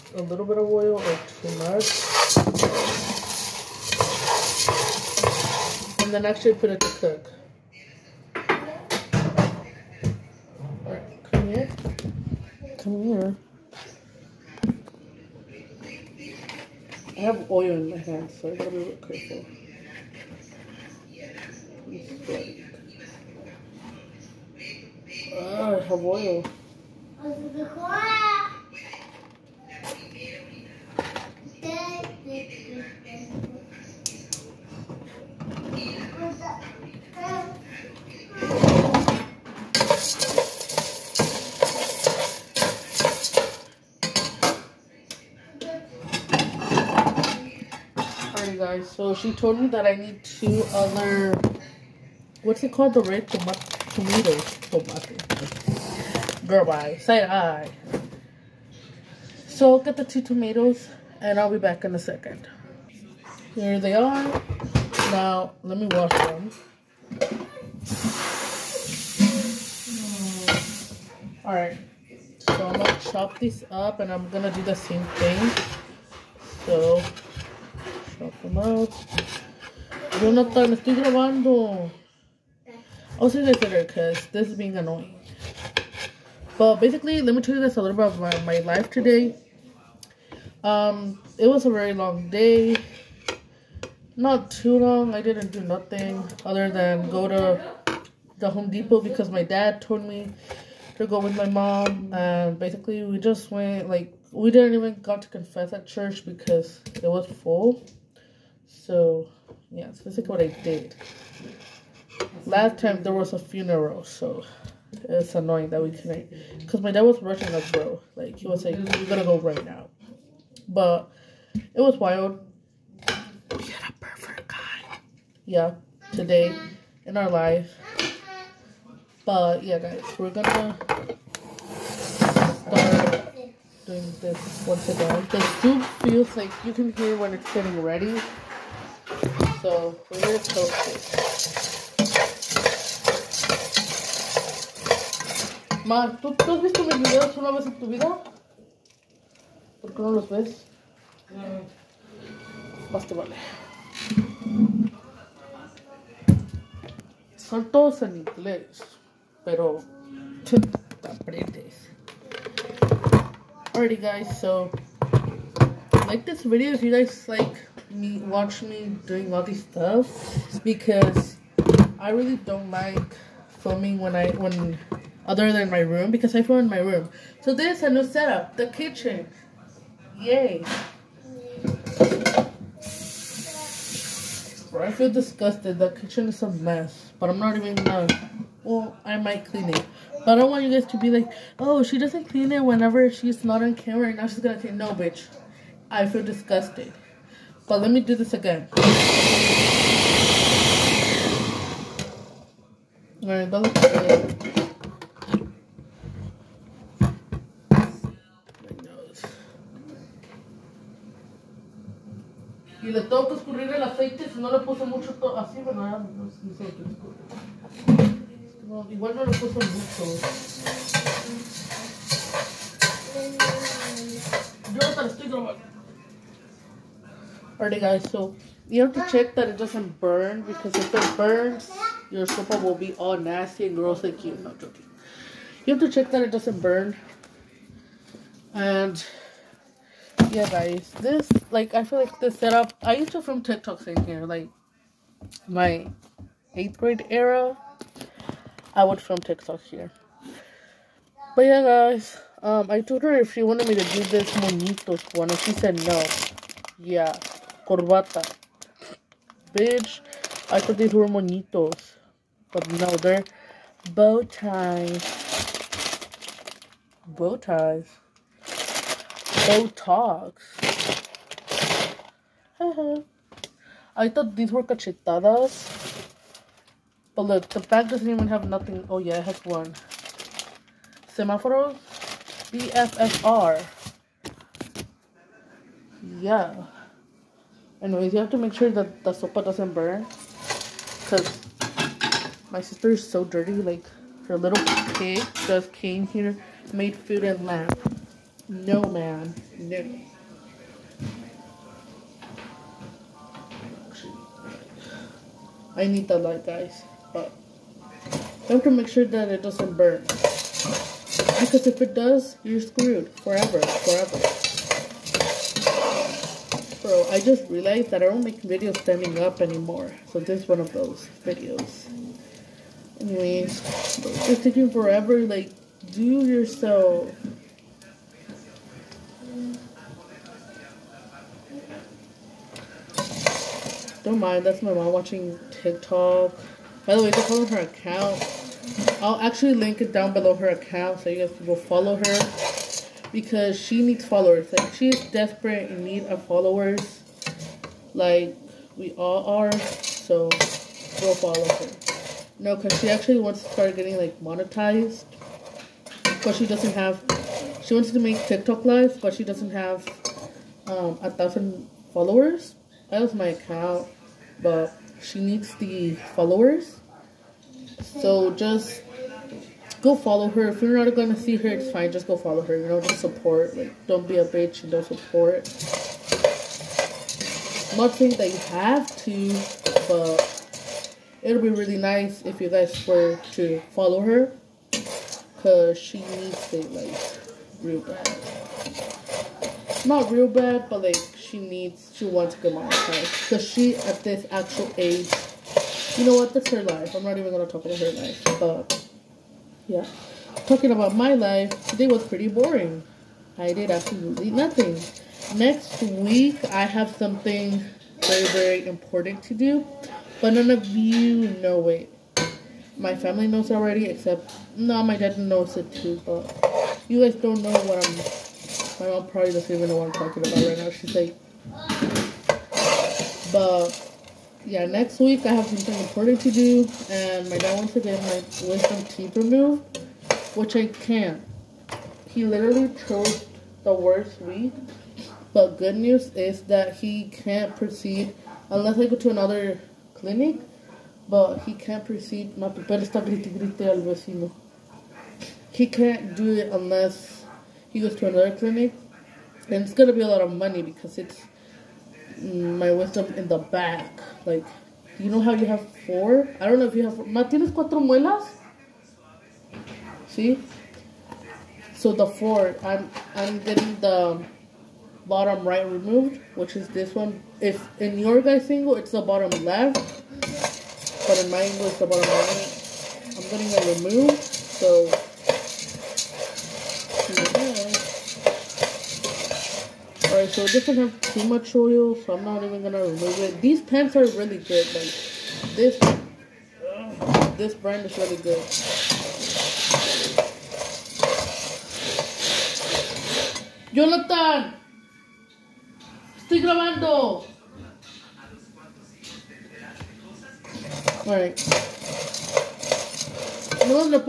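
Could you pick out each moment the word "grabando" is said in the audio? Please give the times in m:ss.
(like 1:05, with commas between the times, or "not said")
1:20, 3:45, 8:16.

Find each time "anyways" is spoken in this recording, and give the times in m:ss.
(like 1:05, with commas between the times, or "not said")
4:47, 5:23.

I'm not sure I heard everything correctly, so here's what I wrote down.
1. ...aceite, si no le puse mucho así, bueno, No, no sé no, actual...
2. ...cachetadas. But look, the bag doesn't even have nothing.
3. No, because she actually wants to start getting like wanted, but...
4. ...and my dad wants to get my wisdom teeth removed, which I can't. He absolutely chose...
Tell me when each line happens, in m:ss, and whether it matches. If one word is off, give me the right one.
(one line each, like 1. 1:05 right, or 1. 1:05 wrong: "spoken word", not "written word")
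1. 3:33 wrong: "igual", not "actual"
2. 4:34 right
3. 5:52 wrong: "monetized", not "wanted"
4. 7:06 wrong: "literally", not "absolutely".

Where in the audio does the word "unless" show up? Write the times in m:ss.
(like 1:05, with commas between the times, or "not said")
7:18, 7:26.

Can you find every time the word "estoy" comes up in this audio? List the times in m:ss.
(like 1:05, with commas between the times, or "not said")
1:20, 3:45, 8:16.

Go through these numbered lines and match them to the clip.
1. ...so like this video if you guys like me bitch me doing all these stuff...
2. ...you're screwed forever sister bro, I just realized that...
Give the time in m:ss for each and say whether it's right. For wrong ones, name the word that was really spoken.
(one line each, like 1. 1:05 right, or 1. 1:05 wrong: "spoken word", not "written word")
1. 2:44 wrong: "watch", not "bitch"
2. 5:12 wrong: "forever", not "sister".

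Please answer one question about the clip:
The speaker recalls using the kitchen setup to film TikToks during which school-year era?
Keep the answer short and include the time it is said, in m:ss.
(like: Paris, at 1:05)
Eighth grade, at 4:06.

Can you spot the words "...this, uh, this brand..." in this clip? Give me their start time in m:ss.
8:05.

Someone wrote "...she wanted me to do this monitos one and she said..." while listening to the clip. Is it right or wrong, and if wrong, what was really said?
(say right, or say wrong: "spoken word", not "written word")
right.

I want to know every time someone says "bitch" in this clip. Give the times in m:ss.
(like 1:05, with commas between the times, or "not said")
3:14, 4:19, 6:14.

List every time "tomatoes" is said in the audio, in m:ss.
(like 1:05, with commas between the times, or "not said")
0:53, 1:00.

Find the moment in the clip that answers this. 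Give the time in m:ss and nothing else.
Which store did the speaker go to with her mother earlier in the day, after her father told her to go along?
1:38.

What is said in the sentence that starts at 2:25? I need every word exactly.
Ma, ¿tú, ¿tú has visto mis videos una vez en tu vida?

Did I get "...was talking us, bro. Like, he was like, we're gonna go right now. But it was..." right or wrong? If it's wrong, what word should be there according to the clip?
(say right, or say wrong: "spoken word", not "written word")
wrong: "rushing", not "talking".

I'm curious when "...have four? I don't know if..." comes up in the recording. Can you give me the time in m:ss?
7:35.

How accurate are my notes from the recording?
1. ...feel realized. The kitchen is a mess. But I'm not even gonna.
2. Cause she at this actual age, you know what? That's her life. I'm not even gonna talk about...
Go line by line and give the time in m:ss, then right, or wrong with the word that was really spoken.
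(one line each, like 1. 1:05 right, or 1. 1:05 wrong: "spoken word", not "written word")
1. 3:04 wrong: "disgusted", not "realized"
2. 6:33 right.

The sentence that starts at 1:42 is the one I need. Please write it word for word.
And basically, we just went, like, we didn't even got to confess at church because it was full.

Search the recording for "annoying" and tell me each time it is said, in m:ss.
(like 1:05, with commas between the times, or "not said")
1:24, 1:55.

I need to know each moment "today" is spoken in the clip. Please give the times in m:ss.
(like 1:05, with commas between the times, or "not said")
1:28, 2:06, 6:41.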